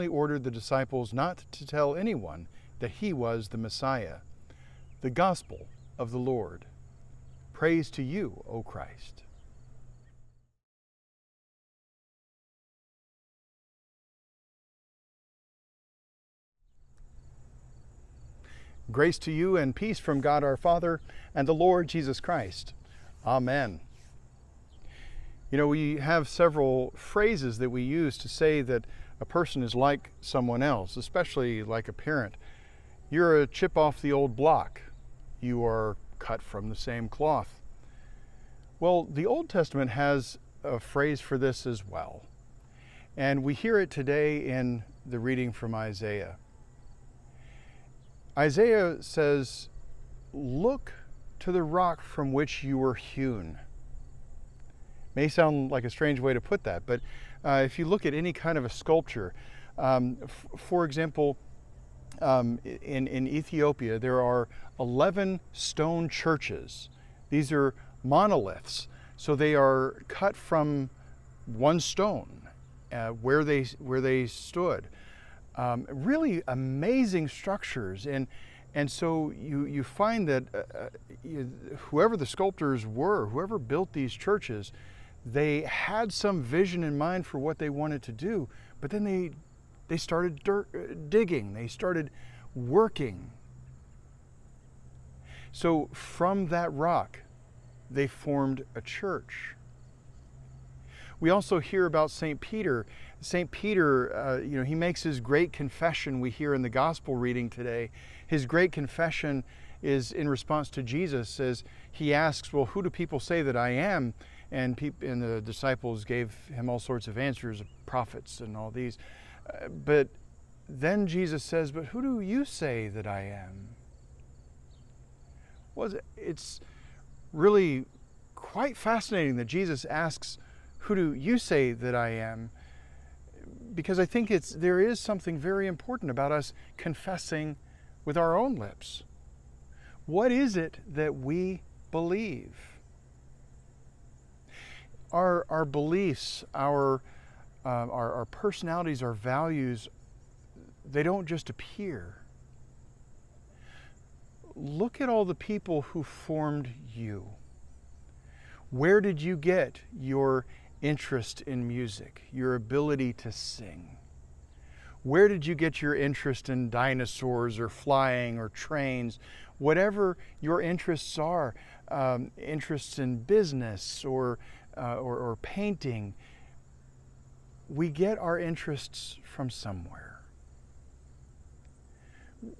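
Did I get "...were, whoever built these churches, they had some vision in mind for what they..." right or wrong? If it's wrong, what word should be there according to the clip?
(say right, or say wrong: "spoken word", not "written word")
right.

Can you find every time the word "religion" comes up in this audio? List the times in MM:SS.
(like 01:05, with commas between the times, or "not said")
not said.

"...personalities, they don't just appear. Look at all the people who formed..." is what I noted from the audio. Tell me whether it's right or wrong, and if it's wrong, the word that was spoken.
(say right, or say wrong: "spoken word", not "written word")
wrong: "values", not "personalities".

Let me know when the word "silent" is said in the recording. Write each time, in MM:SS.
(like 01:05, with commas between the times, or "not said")
not said.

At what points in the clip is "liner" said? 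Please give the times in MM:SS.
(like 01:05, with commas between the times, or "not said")
not said.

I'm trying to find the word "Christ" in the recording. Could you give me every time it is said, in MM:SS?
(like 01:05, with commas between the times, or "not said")
00:08, 00:22.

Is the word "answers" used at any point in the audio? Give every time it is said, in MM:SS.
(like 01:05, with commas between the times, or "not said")
01:57.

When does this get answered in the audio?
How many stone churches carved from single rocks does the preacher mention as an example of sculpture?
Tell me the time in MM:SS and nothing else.
01:04.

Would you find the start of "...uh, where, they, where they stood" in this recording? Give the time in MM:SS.
01:12.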